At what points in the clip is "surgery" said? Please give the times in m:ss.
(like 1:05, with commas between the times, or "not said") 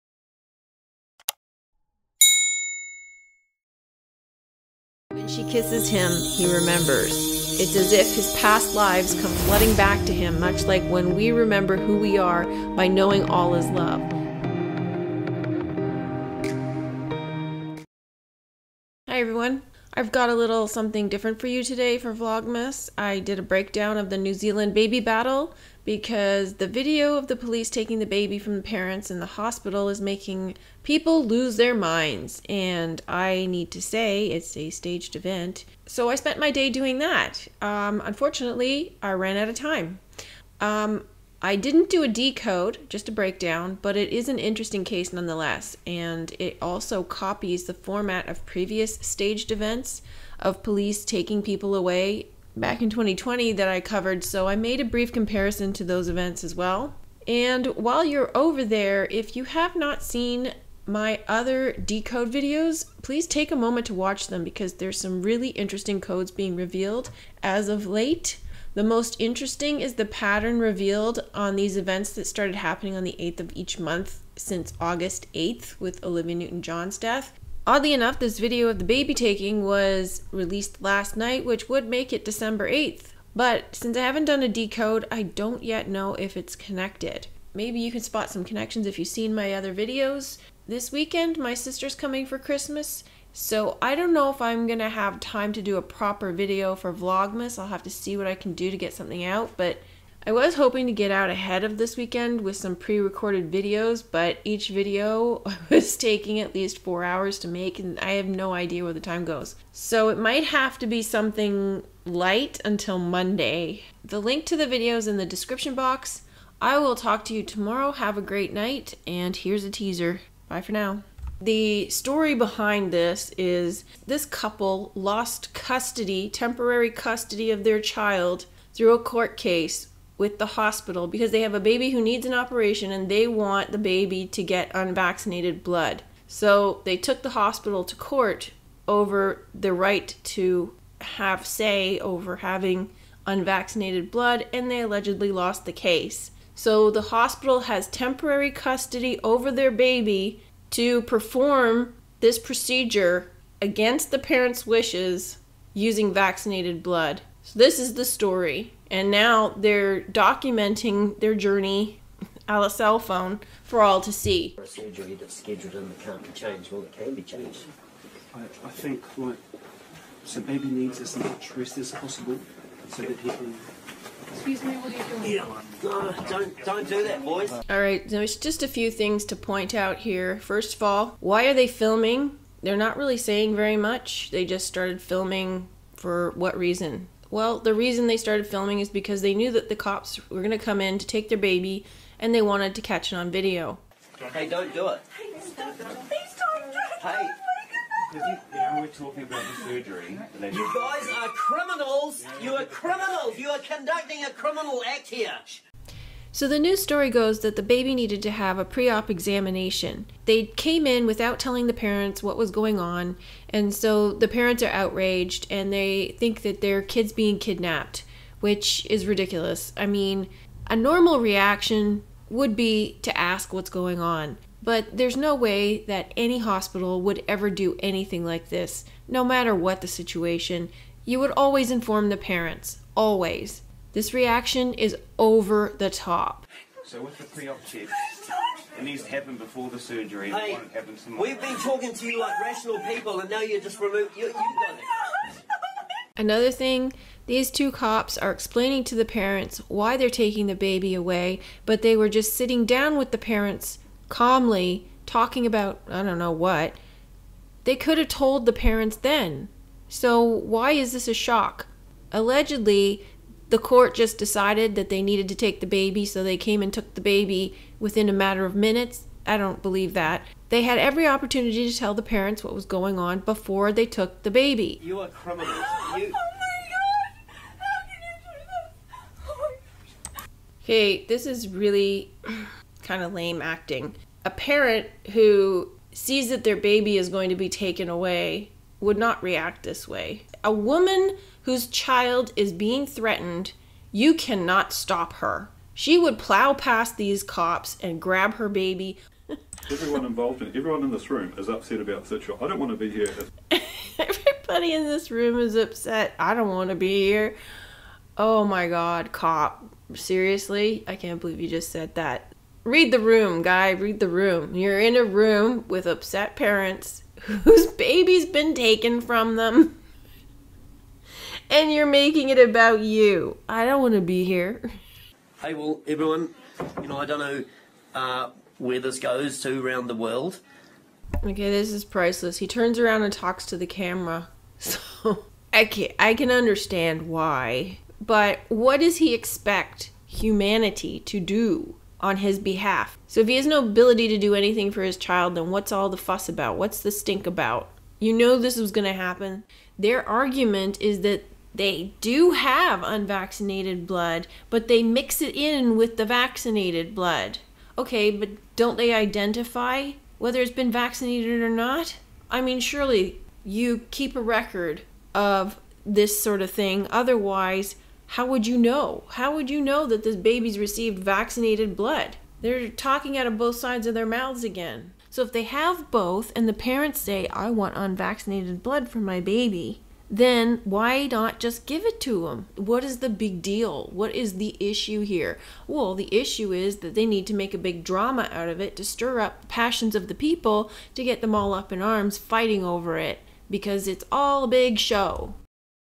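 2:44, 3:19, 3:59.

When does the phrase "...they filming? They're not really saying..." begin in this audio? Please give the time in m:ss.
3:01.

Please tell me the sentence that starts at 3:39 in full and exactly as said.
I mean, a normal reaction would be to ask what's going on.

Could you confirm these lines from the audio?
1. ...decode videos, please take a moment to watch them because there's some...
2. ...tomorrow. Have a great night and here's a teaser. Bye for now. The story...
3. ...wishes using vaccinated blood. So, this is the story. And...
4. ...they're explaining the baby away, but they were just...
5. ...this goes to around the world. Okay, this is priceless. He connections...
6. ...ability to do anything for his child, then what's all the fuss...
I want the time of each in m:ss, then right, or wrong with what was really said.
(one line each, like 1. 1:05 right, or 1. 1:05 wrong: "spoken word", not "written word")
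1. 1:01 right
2. 1:57 right
3. 2:34 right
4. 4:09 wrong: "taking", not "explaining"
5. 5:28 wrong: "turns", not "connections"
6. 5:43 right.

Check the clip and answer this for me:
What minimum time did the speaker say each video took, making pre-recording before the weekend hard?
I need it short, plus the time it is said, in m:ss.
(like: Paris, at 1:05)
4 hours, at 1:46.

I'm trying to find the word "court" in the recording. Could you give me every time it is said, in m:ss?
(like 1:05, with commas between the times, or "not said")
2:08, 2:17, 4:23.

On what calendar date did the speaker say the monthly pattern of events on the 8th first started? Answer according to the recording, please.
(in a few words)
August 8th.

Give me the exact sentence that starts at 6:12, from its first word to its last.
They're talking out of both sides of their mouths again.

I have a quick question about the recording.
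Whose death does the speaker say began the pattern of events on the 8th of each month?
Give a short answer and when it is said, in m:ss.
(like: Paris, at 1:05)
Olivia Newton John, at 1:16.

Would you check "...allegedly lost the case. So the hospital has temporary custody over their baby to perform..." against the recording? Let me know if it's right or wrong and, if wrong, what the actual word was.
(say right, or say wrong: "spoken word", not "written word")
right.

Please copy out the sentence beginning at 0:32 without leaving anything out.
And I need to say it's a staged event.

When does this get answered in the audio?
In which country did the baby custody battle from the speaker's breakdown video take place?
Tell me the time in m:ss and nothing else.
0:24.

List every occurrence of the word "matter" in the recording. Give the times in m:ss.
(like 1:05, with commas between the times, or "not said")
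3:49, 4:28.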